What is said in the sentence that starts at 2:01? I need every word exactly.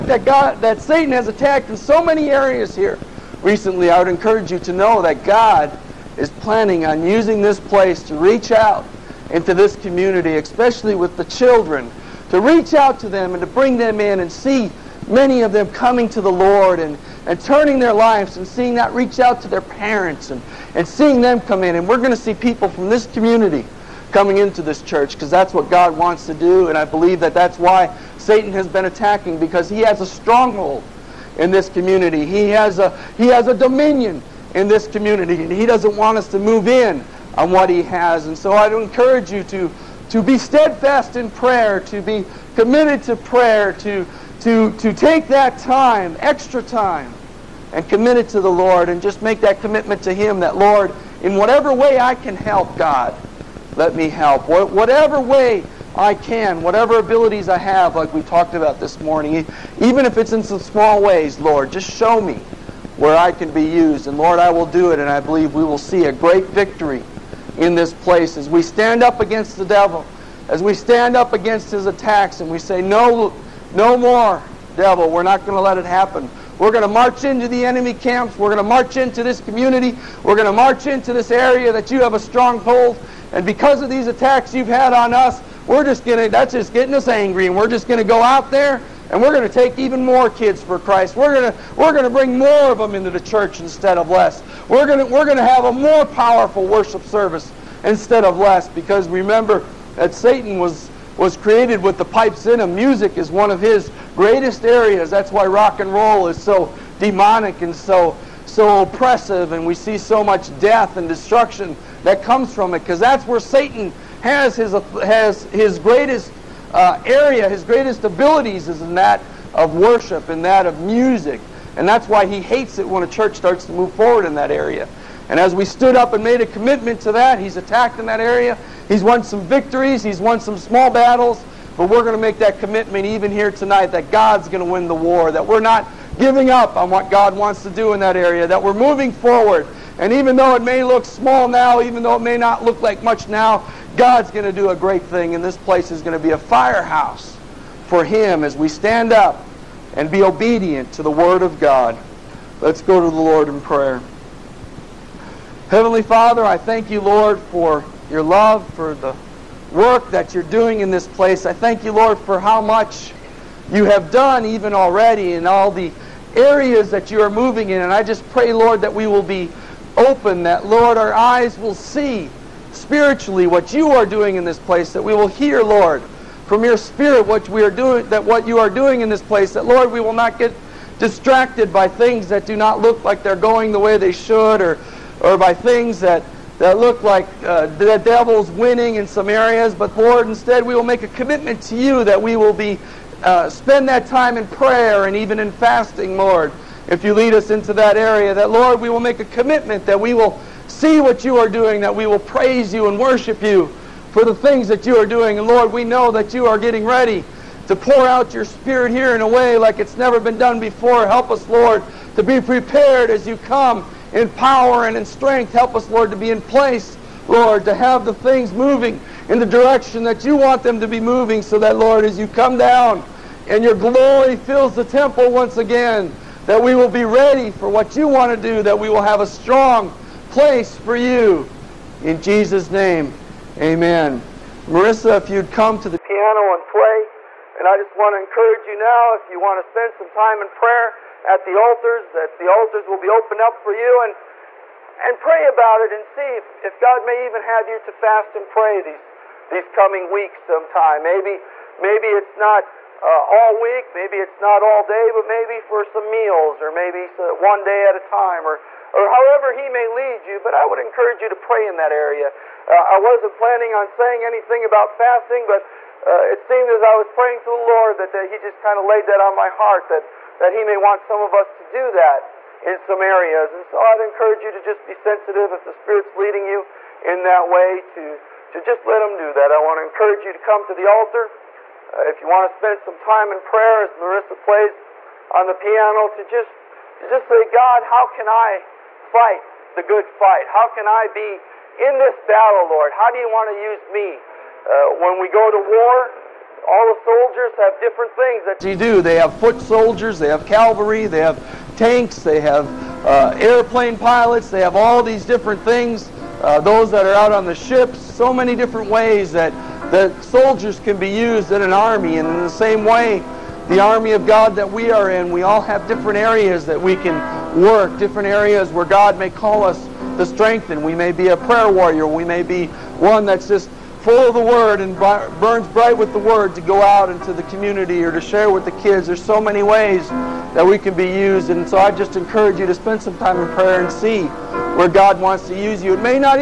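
And that's why he hates it when a church starts to move forward in that area.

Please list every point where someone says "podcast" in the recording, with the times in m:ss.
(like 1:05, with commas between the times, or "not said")
not said.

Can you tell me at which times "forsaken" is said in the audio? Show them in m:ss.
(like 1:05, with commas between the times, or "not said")
not said.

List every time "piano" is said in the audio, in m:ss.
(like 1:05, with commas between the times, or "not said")
3:55, 4:45.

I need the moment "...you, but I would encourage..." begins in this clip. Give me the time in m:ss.
4:20.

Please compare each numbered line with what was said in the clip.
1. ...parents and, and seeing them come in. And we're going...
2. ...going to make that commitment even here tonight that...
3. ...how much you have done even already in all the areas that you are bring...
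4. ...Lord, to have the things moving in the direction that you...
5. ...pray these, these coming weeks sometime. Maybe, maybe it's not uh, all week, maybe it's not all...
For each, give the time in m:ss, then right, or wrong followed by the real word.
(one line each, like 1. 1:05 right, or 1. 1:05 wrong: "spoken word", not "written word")
1. 0:19 right
2. 2:12 right
3. 2:42 wrong: "moving", not "bring"
4. 3:37 right
5. 4:08 right.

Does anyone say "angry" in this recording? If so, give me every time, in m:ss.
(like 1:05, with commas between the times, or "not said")
1:27.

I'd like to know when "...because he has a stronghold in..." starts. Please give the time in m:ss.
0:29.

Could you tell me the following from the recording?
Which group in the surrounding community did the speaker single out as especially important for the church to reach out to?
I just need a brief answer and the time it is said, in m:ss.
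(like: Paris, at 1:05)
children, at 0:11.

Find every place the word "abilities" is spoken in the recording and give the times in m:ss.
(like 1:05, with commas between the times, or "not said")
0:56, 1:58.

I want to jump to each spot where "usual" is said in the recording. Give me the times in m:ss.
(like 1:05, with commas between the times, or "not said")
not said.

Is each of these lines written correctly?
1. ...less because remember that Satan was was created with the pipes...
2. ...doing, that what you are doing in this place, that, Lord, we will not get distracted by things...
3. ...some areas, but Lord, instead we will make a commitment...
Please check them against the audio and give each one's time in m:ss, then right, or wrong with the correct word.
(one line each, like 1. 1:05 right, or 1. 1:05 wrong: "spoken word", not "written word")
1. 1:38 right
2. 2:57 right
3. 3:09 right.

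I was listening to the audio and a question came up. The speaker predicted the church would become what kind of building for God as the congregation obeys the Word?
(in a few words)
a firehouse.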